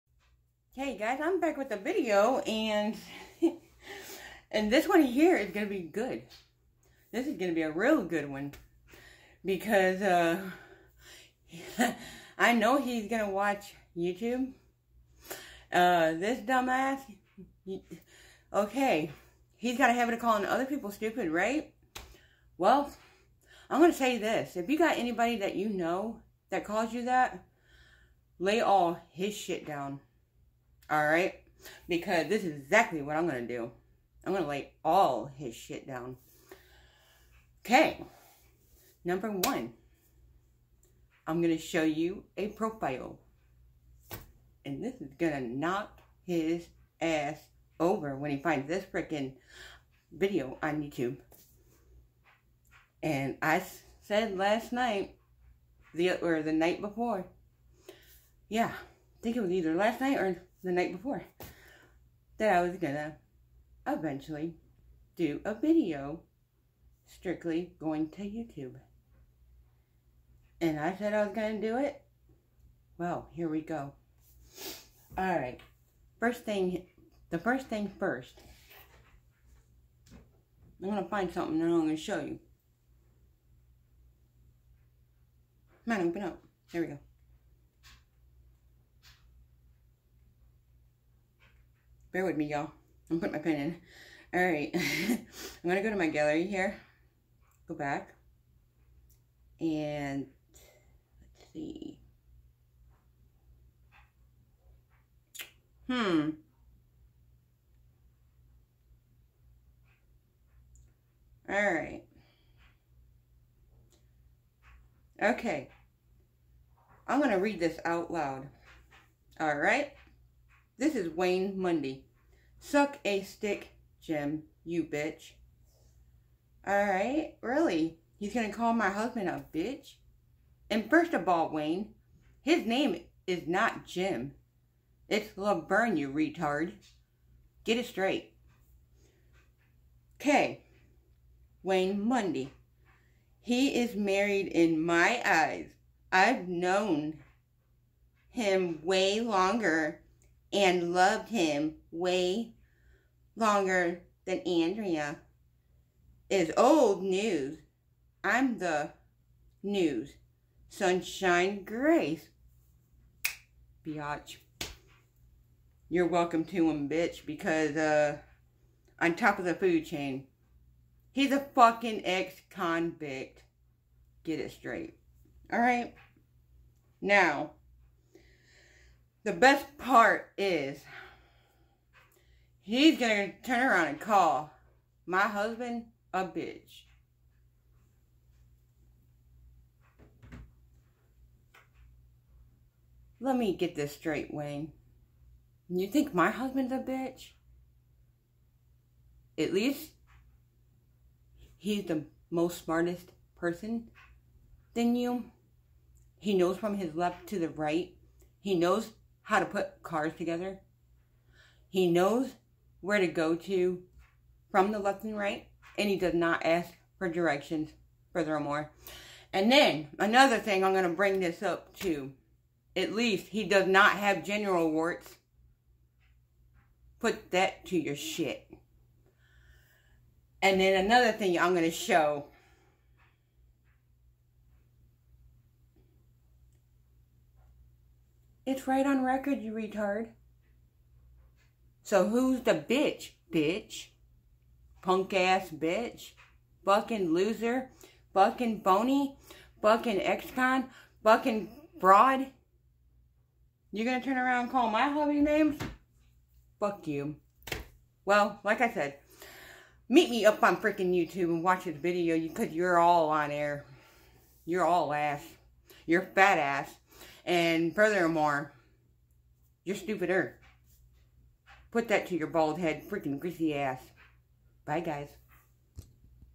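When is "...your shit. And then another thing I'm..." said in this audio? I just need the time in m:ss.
3:47.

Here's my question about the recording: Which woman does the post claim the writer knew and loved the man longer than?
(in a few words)
Andrea.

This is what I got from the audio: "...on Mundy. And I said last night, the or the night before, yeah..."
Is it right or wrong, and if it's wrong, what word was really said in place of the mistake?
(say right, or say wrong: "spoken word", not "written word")
wrong: "YouTube", not "Mundy".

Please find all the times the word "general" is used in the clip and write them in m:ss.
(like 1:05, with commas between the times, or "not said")
3:44.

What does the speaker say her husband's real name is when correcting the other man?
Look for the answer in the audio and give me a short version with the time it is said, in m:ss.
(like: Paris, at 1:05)
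LaBurn, at 2:15.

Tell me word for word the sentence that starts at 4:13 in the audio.
You're gonna turn around and call my hubby names?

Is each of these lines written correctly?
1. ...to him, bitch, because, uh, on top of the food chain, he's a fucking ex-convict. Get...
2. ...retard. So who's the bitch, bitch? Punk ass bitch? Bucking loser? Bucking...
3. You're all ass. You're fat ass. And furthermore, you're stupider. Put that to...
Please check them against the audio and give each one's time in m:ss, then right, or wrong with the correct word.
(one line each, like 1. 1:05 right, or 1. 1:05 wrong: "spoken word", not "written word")
1. 2:46 right
2. 3:59 right
3. 4:24 right.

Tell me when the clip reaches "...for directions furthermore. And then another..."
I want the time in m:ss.
3:36.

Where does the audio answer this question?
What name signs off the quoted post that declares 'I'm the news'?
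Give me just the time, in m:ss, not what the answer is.
2:40.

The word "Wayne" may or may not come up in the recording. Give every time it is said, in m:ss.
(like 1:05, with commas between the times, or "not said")
2:01, 2:11, 2:21, 3:14.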